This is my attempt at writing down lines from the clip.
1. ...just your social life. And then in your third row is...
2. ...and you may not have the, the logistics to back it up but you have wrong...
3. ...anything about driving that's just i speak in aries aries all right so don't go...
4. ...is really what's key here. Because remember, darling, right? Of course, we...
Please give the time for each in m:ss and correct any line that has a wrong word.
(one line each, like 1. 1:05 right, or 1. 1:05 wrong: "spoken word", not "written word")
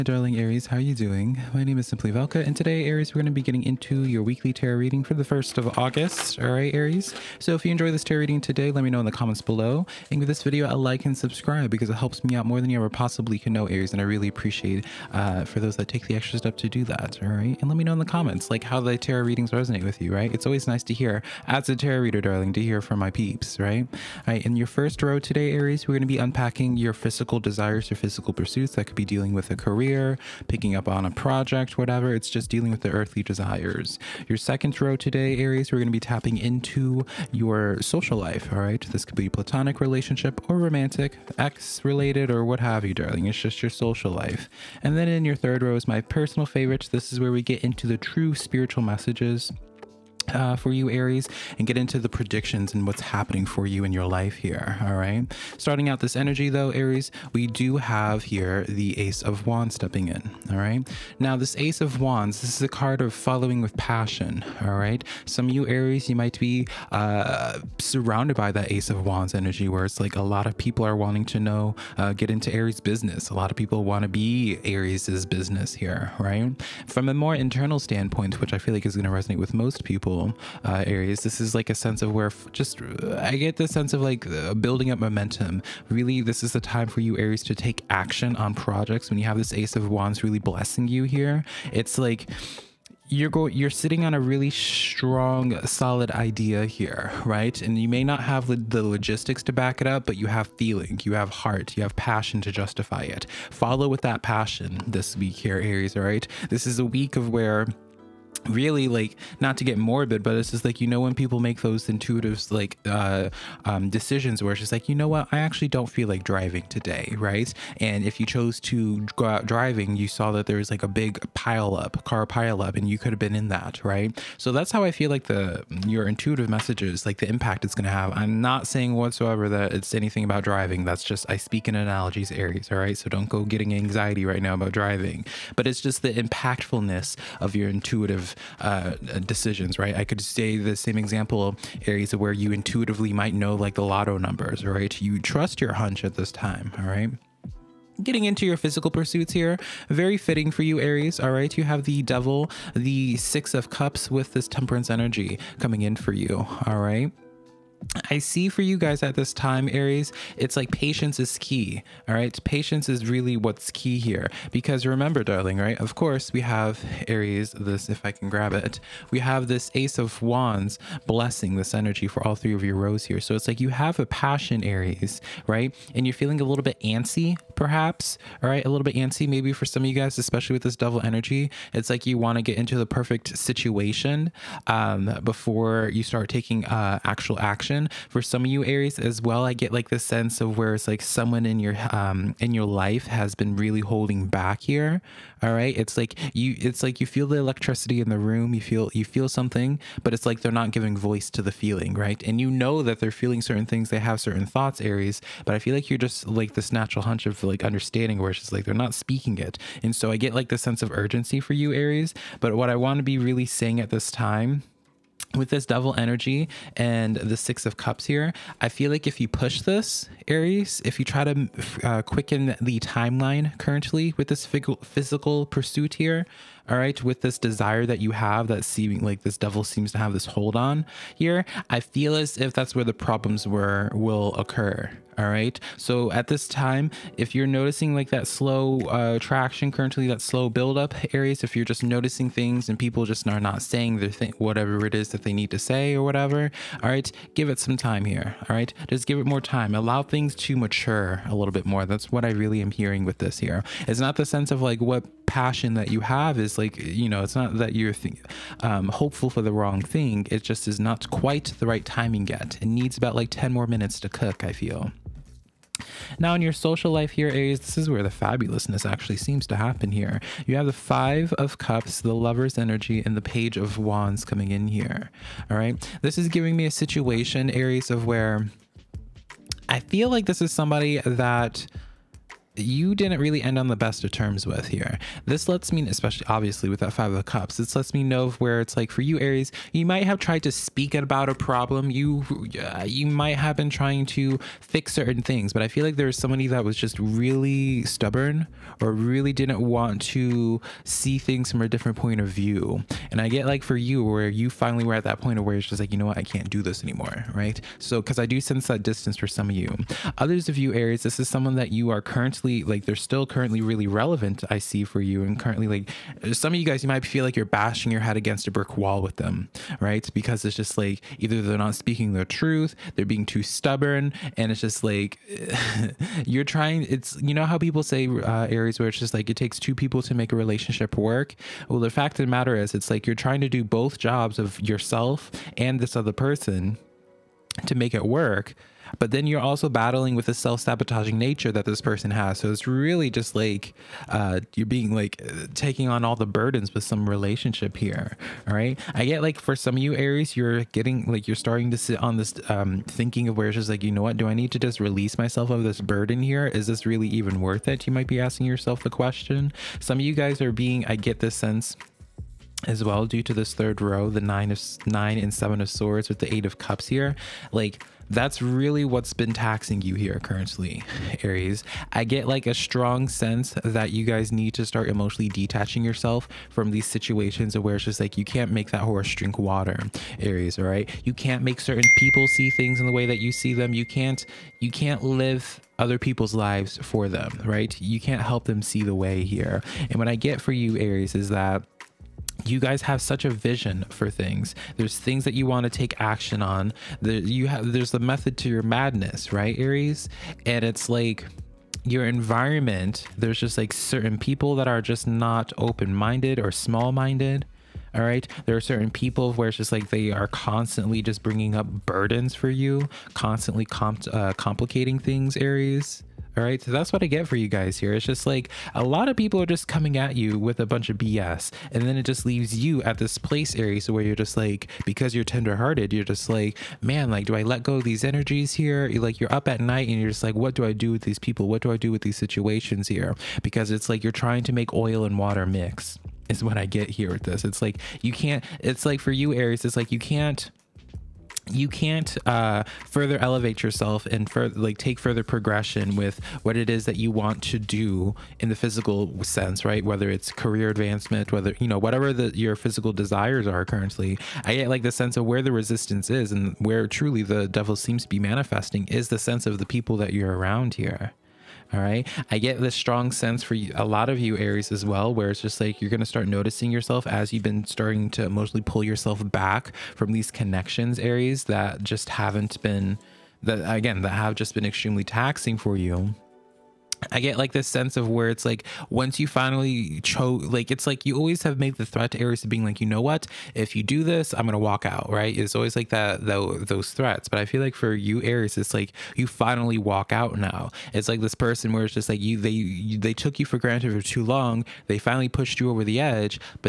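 1. 0:43 right
2. 1:37 wrong: "feeling", not "wrong"
3. 2:09 wrong: "analogies", not "aries"
4. 2:42 right.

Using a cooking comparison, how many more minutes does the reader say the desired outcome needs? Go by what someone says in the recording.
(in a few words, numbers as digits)
10.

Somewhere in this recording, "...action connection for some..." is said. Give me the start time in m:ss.
3:07.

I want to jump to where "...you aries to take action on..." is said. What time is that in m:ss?
1:26.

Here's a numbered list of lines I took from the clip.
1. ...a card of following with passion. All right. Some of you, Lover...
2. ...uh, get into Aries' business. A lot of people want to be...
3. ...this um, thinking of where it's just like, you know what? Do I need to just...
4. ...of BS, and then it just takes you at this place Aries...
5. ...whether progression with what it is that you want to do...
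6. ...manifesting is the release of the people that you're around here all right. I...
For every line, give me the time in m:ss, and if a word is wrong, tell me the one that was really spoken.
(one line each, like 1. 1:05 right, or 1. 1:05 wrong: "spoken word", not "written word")
1. 1:02 wrong: "Aries", not "Lover"
2. 1:11 right
3. 5:52 right
4. 7:00 wrong: "leaves", not "takes"
5. 7:24 wrong: "further", not "whether"
6. 7:38 wrong: "sense", not "release".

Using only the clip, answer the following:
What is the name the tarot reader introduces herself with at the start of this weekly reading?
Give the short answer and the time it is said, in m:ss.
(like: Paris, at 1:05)
Simply Velca, at 0:01.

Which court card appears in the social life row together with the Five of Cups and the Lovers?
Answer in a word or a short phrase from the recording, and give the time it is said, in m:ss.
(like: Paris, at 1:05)
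Page of Wands, at 4:33.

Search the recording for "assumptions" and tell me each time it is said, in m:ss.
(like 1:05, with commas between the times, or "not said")
not said.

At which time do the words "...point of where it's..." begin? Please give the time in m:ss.
5:05.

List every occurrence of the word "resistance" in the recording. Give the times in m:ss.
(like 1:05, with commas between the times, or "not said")
7:35.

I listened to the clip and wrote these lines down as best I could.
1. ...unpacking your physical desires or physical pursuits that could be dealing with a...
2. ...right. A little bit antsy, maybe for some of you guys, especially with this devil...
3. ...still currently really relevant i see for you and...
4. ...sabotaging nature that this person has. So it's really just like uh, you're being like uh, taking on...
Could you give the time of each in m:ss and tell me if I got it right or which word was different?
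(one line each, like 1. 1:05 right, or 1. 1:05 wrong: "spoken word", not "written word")
1. 0:26 right
2. 2:58 right
3. 5:12 right
4. 5:40 right.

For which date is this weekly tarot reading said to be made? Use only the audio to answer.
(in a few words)
1st of August.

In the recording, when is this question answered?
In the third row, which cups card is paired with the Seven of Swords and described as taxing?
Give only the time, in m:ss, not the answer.
6:06.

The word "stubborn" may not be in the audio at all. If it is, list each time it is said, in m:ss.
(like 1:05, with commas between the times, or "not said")
4:57, 5:23.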